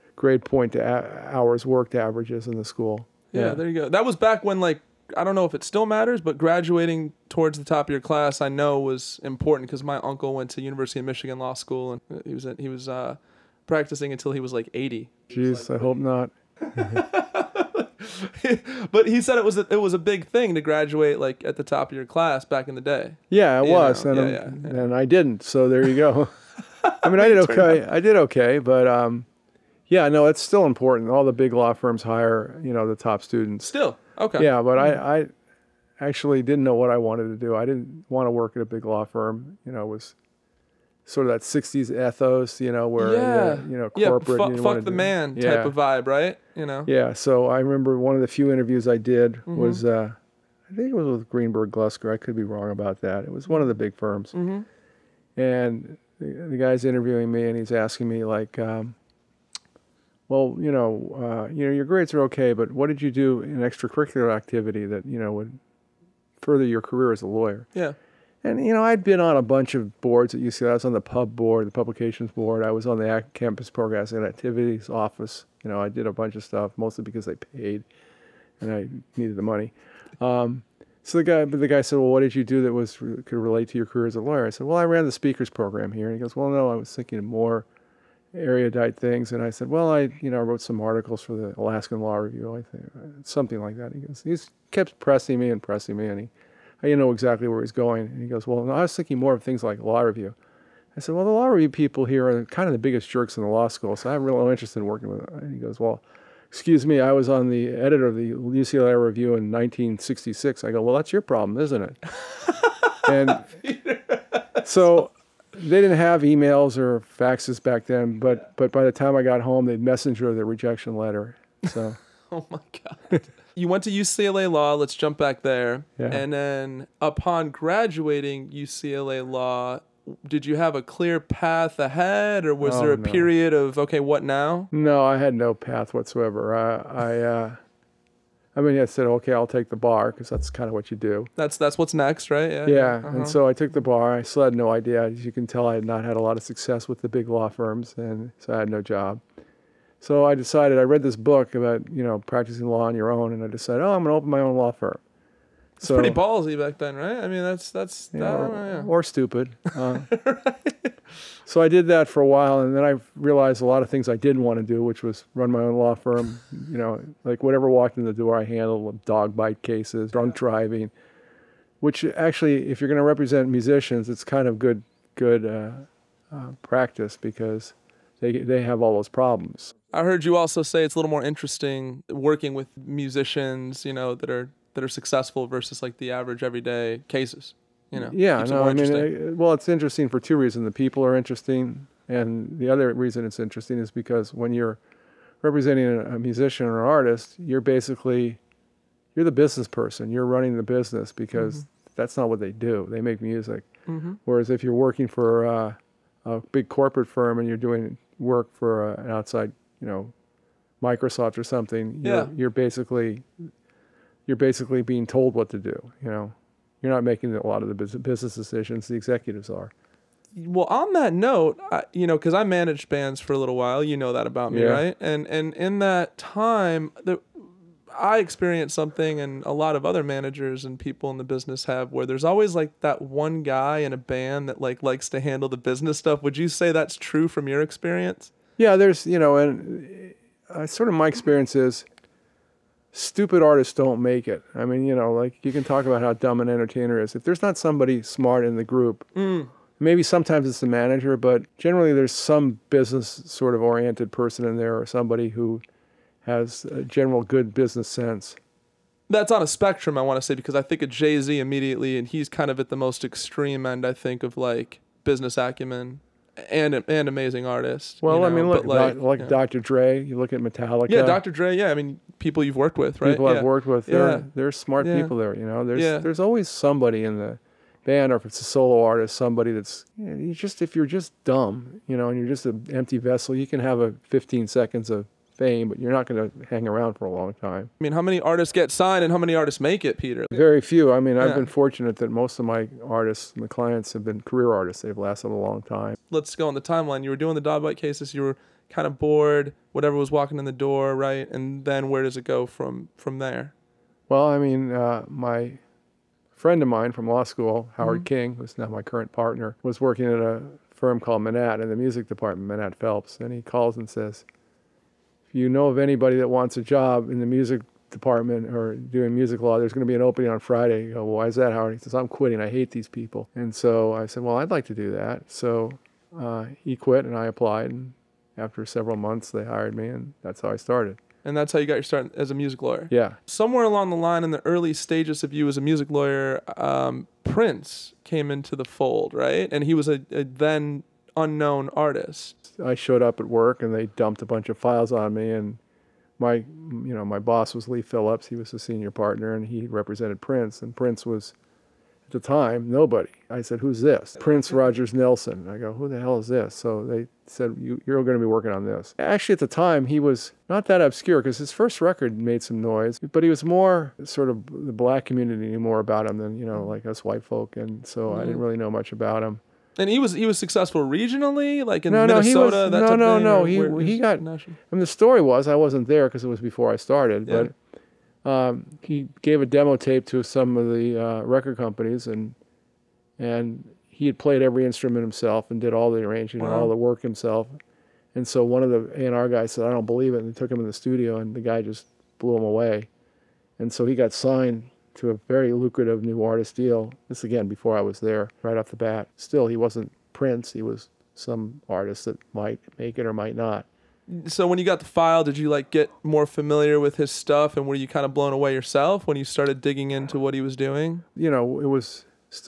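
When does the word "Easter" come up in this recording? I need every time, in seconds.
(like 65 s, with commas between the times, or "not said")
not said.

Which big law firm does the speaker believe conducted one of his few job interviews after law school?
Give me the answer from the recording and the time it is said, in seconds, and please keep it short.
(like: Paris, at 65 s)
Greenberg Glusker, at 51 s.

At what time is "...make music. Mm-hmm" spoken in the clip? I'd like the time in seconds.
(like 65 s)
203 s.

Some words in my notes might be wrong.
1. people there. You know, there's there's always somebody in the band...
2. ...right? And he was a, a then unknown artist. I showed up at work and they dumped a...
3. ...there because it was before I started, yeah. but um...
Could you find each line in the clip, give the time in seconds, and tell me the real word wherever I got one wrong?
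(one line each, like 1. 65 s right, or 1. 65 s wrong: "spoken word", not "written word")
1. 275 s right
2. 339 s right
3. 375 s right.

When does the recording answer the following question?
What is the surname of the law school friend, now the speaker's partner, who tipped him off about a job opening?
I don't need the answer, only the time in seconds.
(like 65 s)
308 s.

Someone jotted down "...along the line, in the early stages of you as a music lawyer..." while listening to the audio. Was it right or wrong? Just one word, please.
right.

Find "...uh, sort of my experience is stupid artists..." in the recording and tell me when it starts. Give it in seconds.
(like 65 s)
240 s.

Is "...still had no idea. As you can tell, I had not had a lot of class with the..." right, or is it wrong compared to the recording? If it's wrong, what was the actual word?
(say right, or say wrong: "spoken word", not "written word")
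wrong: "success", not "class".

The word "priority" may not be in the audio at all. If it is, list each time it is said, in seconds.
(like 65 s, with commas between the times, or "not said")
not said.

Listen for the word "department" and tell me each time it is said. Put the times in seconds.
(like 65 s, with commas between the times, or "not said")
312 s, 317 s.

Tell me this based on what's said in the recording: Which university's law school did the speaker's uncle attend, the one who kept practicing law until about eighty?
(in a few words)
University of Michigan.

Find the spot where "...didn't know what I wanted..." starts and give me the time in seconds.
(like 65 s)
36 s.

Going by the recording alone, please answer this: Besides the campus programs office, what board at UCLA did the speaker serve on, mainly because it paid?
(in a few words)
Publications board.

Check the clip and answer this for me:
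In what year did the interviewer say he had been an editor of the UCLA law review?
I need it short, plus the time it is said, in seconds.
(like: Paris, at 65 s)
1966, at 109 s.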